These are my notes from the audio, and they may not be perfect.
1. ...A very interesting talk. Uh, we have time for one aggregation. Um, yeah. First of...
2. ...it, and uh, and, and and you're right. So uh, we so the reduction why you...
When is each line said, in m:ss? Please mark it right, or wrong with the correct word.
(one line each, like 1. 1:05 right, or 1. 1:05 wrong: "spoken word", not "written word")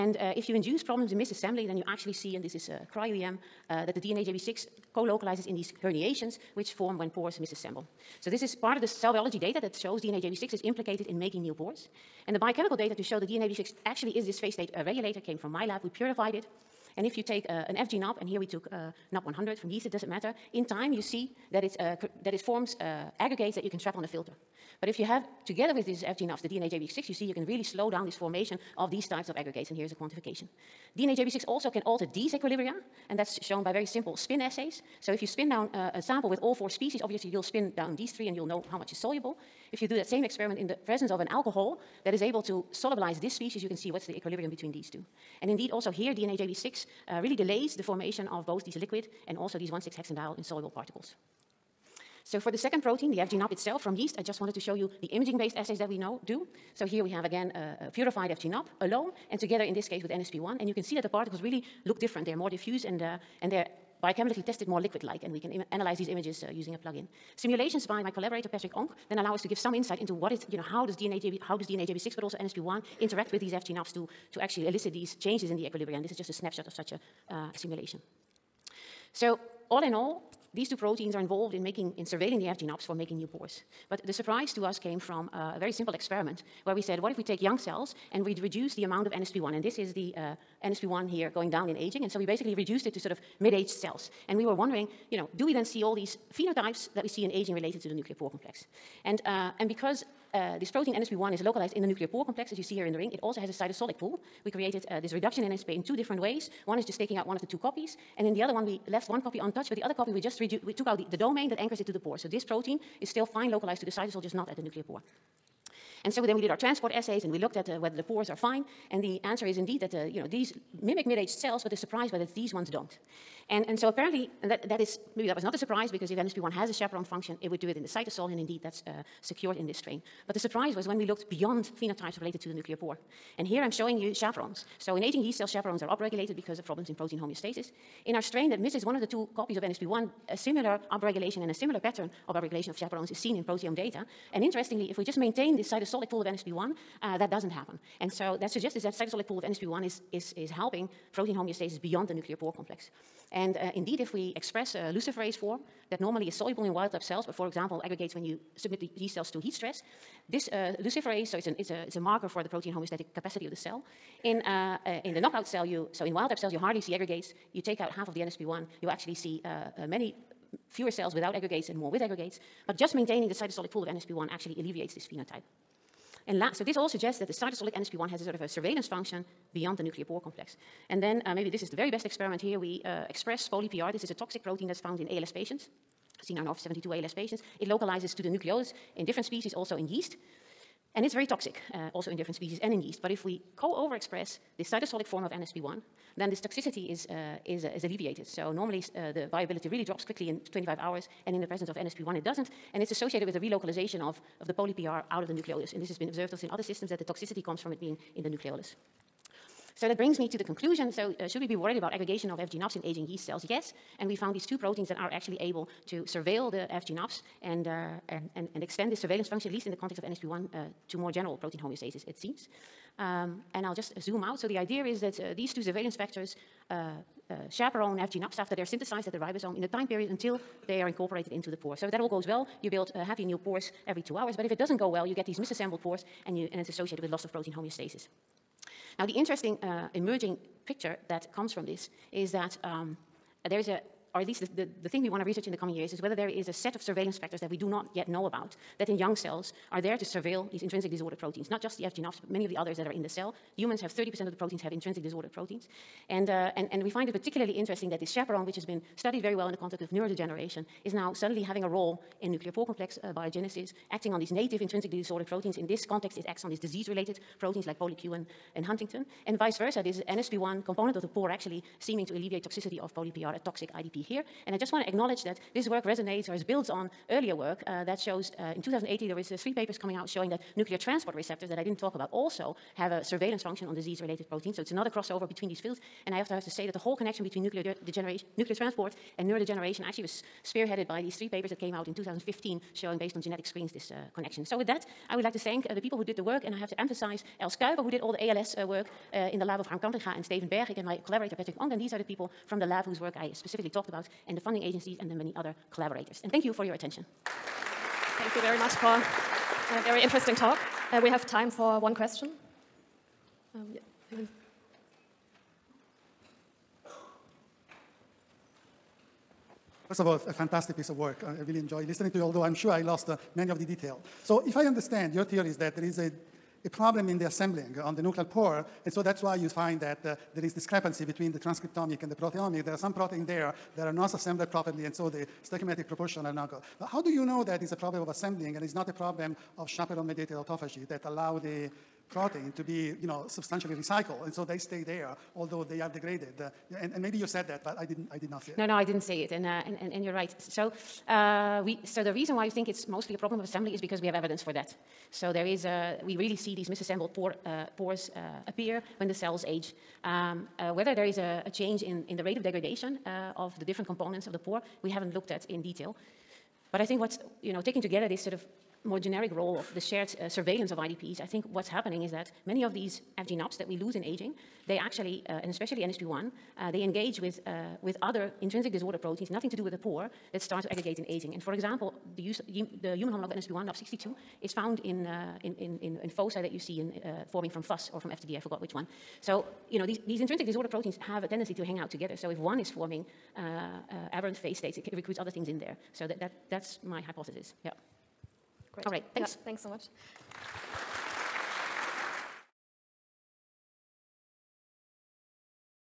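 1. 5:09 wrong: "question", not "aggregation"
2. 5:49 wrong: "reason", not "reduction".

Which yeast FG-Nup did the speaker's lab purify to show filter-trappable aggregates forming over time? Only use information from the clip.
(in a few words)
Nup100.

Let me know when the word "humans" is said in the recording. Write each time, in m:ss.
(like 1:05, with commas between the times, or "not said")
4:13, 6:22.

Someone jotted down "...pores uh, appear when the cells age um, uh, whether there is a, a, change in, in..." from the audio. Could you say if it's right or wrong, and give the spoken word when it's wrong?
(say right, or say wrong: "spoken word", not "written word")
right.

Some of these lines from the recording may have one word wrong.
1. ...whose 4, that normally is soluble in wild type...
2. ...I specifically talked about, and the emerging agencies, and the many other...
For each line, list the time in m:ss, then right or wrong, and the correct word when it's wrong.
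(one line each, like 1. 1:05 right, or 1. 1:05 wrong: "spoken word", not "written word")
1. 2:34 wrong: "luciferase", not "whose"
2. 5:03 wrong: "funding", not "emerging".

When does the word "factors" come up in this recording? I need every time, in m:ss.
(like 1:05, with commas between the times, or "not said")
3:45, 4:07.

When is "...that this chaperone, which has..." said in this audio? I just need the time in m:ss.
4:17.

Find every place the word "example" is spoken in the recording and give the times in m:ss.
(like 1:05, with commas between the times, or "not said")
2:37, 6:21.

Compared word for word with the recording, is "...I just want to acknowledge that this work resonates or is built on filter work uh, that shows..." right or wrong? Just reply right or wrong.
wrong.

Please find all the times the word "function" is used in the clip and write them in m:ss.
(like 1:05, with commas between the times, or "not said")
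2:07, 2:58, 3:39, 4:43.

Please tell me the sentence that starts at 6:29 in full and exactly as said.
So, you know, these, these intrinsic disorder proteins have a tendency to hang out together.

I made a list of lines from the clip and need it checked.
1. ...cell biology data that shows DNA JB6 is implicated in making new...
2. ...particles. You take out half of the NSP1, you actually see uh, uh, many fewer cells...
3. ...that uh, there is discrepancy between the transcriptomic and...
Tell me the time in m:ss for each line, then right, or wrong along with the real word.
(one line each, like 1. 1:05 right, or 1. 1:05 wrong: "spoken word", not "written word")
1. 0:08 right
2. 2:46 wrong: "aggregates", not "particles"
3. 5:29 right.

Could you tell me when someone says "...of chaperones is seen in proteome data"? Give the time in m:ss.
2:22.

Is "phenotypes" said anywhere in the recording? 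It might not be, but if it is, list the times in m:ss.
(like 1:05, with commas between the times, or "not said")
1:36, 2:11, 2:55.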